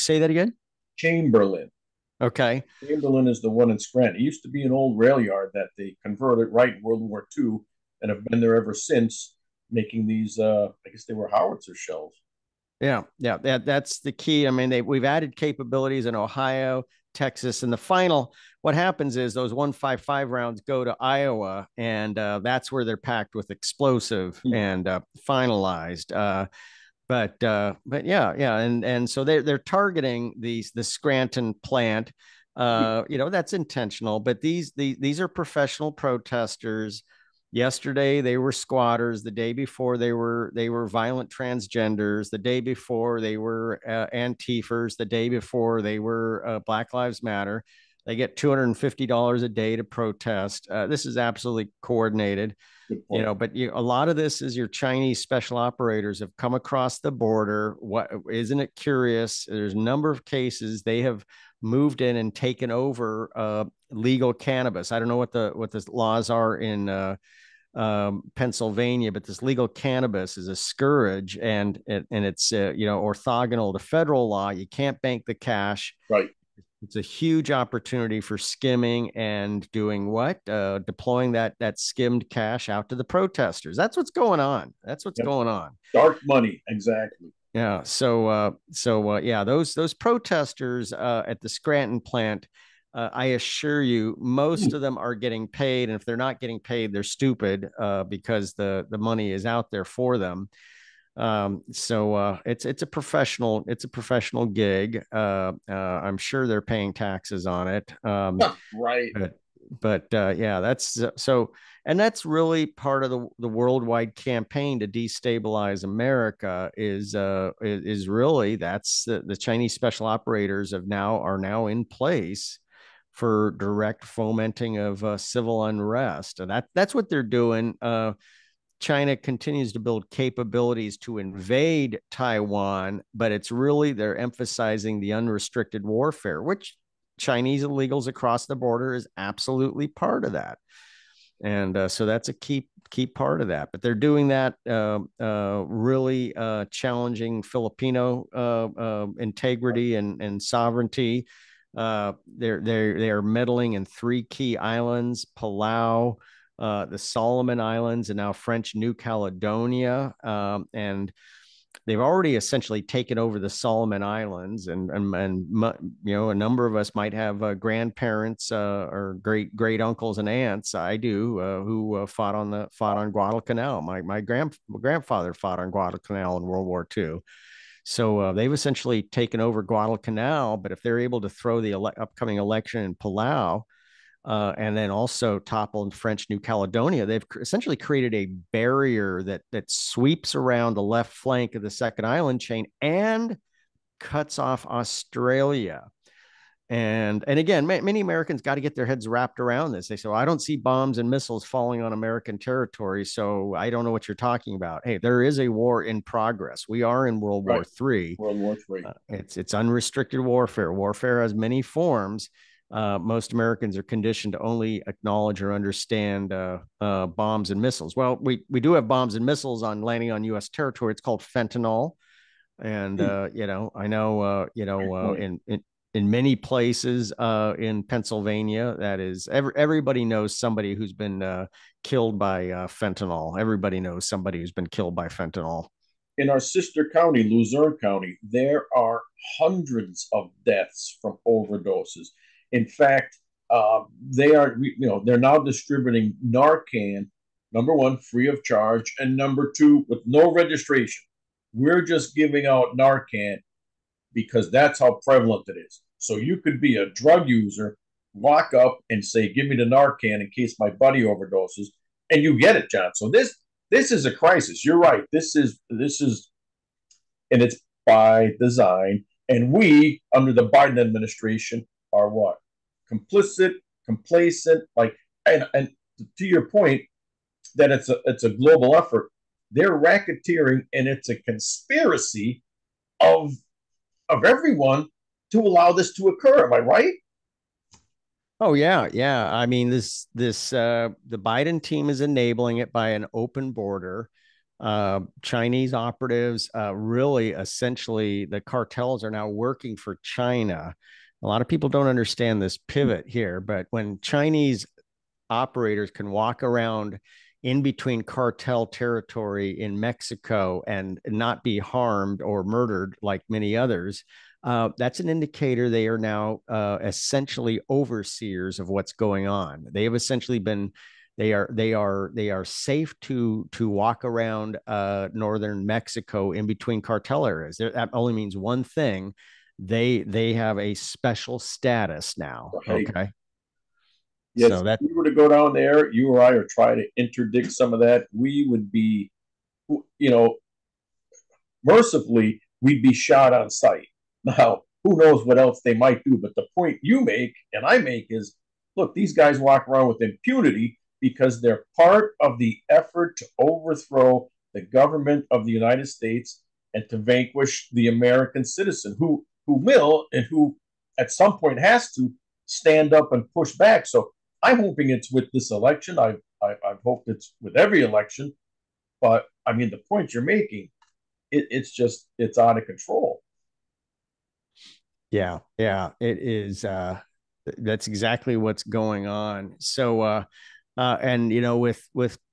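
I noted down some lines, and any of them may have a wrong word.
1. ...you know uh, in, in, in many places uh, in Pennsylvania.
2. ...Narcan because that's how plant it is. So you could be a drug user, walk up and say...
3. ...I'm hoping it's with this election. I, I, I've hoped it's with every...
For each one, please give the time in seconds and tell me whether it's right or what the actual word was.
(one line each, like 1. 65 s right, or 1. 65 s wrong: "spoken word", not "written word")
1. 224 s right
2. 252 s wrong: "prevalent", not "plant"
3. 364 s right.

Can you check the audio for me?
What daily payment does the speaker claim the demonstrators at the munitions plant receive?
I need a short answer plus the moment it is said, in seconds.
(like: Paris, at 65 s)
$250, at 48 s.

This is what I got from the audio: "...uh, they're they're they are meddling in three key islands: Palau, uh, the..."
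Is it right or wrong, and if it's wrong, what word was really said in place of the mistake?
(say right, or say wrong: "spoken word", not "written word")
right.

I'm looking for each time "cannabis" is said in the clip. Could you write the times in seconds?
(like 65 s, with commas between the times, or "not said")
64 s, 69 s.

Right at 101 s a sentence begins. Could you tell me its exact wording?
Um, so uh, it's it's a professional it's a professional gig.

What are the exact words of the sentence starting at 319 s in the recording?
They have essentially been they are they are they are safe to to walk around uh, northern Mexico in between cartel areas.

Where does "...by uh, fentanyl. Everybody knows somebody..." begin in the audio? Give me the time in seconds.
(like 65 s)
232 s.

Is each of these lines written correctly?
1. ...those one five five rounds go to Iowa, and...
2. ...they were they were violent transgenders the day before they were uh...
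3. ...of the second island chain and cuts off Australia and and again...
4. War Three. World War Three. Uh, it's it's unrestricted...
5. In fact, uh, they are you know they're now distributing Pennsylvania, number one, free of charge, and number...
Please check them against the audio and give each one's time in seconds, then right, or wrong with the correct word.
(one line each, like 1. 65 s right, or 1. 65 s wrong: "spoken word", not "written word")
1. 19 s right
2. 39 s right
3. 191 s right
4. 207 s right
5. 242 s wrong: "Narcan", not "Pennsylvania".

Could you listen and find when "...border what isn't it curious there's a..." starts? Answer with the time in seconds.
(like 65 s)
57 s.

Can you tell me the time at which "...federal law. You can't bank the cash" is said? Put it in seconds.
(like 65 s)
73 s.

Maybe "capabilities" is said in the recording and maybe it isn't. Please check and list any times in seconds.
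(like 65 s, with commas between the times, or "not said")
15 s, 130 s.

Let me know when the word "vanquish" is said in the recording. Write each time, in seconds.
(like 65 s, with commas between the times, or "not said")
356 s.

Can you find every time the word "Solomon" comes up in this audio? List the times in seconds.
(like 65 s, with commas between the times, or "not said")
156 s, 163 s.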